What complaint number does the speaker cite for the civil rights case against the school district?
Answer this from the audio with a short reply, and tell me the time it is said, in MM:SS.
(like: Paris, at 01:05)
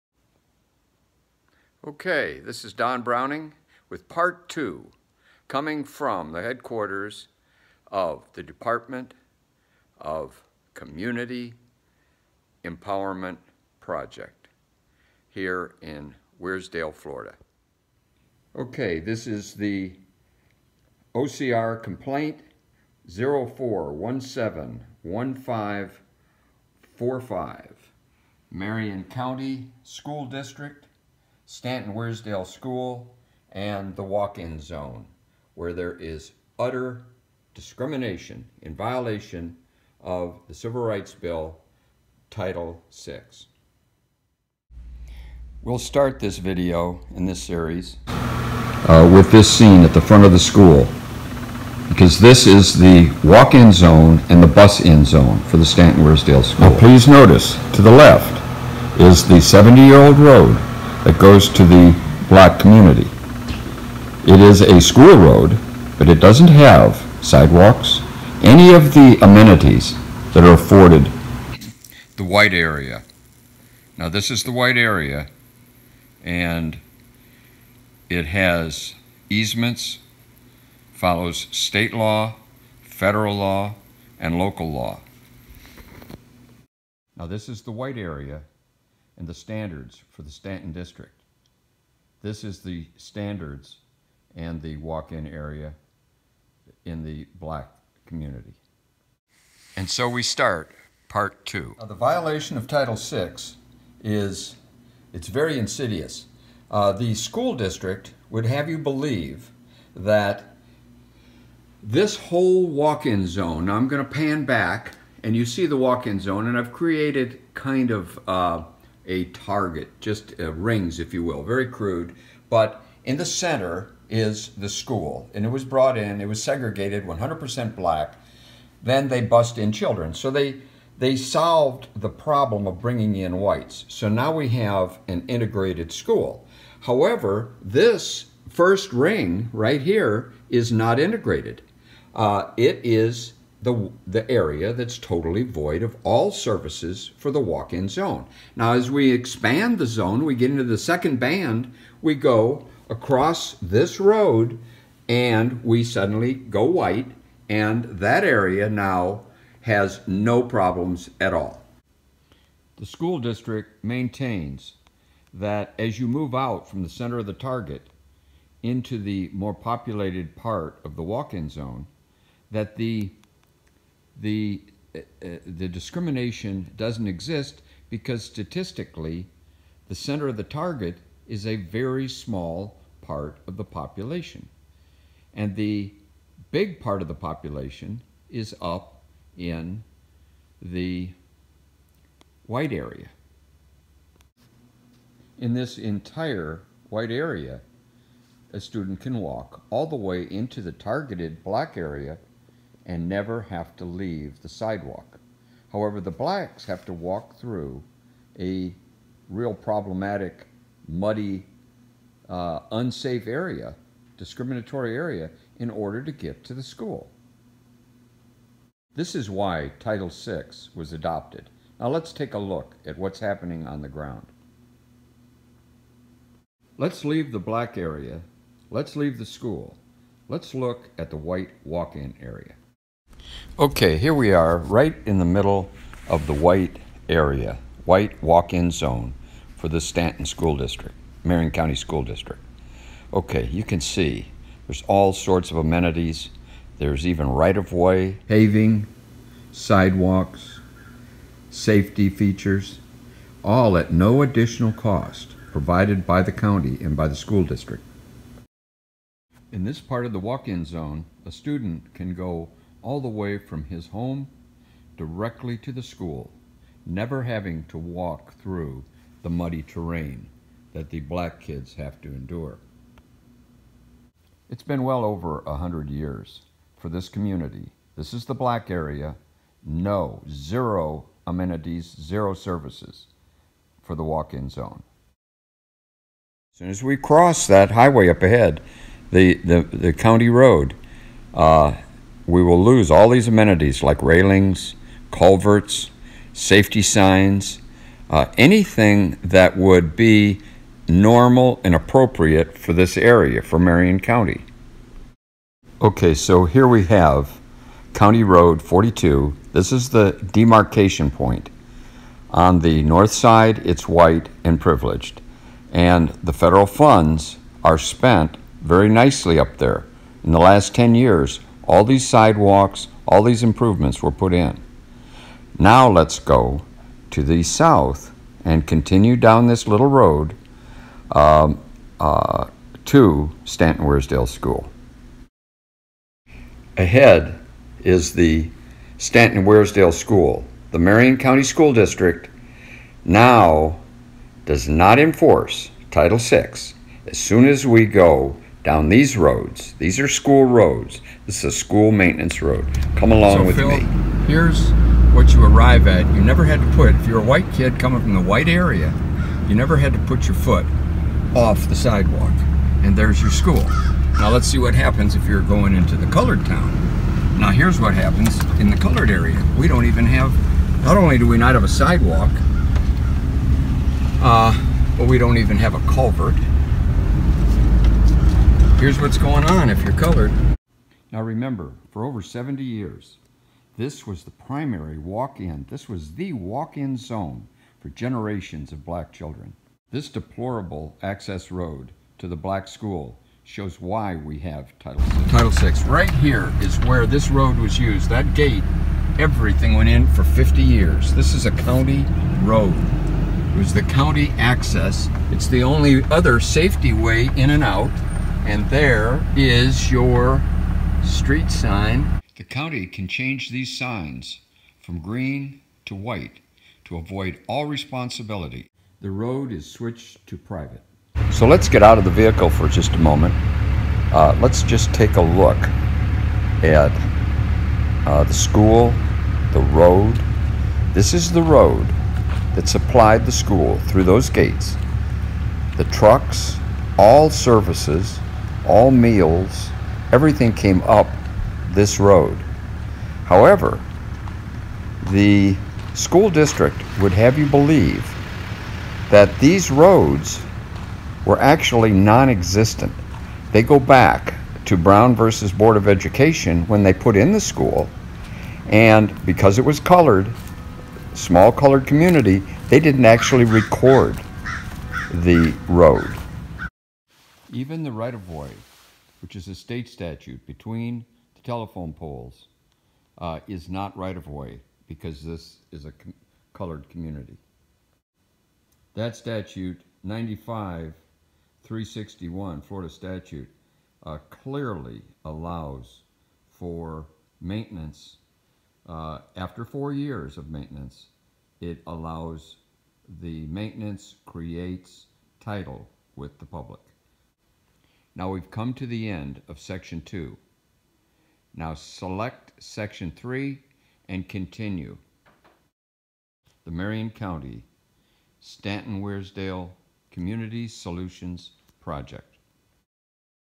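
04171545, at 00:23.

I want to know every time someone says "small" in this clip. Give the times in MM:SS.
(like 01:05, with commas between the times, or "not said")
03:02, 07:41.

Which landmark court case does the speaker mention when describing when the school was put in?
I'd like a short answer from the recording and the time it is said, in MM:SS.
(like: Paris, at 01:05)
Brown versus Board of Education, at 07:34.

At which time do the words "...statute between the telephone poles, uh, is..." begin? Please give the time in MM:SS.
07:49.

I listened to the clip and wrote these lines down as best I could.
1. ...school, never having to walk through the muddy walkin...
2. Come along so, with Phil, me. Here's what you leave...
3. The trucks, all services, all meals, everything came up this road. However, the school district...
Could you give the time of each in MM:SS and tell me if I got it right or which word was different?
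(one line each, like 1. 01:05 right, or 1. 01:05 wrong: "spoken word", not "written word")
1. 04:25 wrong: "terrain", not "walkin"
2. 05:52 wrong: "arrive", not "leave"
3. 07:15 right.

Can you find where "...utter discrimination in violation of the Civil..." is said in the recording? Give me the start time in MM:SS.
00:36.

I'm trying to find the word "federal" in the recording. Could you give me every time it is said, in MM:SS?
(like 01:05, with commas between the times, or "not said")
01:22, 05:16.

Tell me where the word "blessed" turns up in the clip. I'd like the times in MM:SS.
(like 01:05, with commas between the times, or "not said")
not said.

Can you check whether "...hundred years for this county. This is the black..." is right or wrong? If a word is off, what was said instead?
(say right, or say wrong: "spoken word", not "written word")
wrong: "community", not "county".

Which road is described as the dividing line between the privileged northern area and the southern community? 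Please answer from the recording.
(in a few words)
County Road 42.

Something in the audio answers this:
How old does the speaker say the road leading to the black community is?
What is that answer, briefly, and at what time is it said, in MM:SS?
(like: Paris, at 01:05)
70 years, at 00:59.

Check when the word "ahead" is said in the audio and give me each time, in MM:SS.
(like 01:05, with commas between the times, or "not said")
04:48, 05:36.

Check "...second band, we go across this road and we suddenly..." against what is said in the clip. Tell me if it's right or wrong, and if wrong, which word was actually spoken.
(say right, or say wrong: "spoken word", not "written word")
right.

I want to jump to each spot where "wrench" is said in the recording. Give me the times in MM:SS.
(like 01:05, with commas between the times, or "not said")
not said.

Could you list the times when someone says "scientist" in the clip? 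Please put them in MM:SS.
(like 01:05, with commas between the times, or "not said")
not said.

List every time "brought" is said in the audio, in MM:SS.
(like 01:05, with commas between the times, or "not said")
02:05.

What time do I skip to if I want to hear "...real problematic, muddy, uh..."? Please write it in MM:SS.
03:29.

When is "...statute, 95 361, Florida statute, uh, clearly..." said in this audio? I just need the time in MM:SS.
07:59.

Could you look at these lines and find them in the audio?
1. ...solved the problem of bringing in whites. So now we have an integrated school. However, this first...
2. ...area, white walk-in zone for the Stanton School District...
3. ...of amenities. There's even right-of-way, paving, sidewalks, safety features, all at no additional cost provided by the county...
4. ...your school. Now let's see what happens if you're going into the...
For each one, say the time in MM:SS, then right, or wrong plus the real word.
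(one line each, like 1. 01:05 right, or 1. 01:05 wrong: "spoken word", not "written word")
1. 02:11 right
2. 03:57 right
3. 04:05 right
4. 06:03 right.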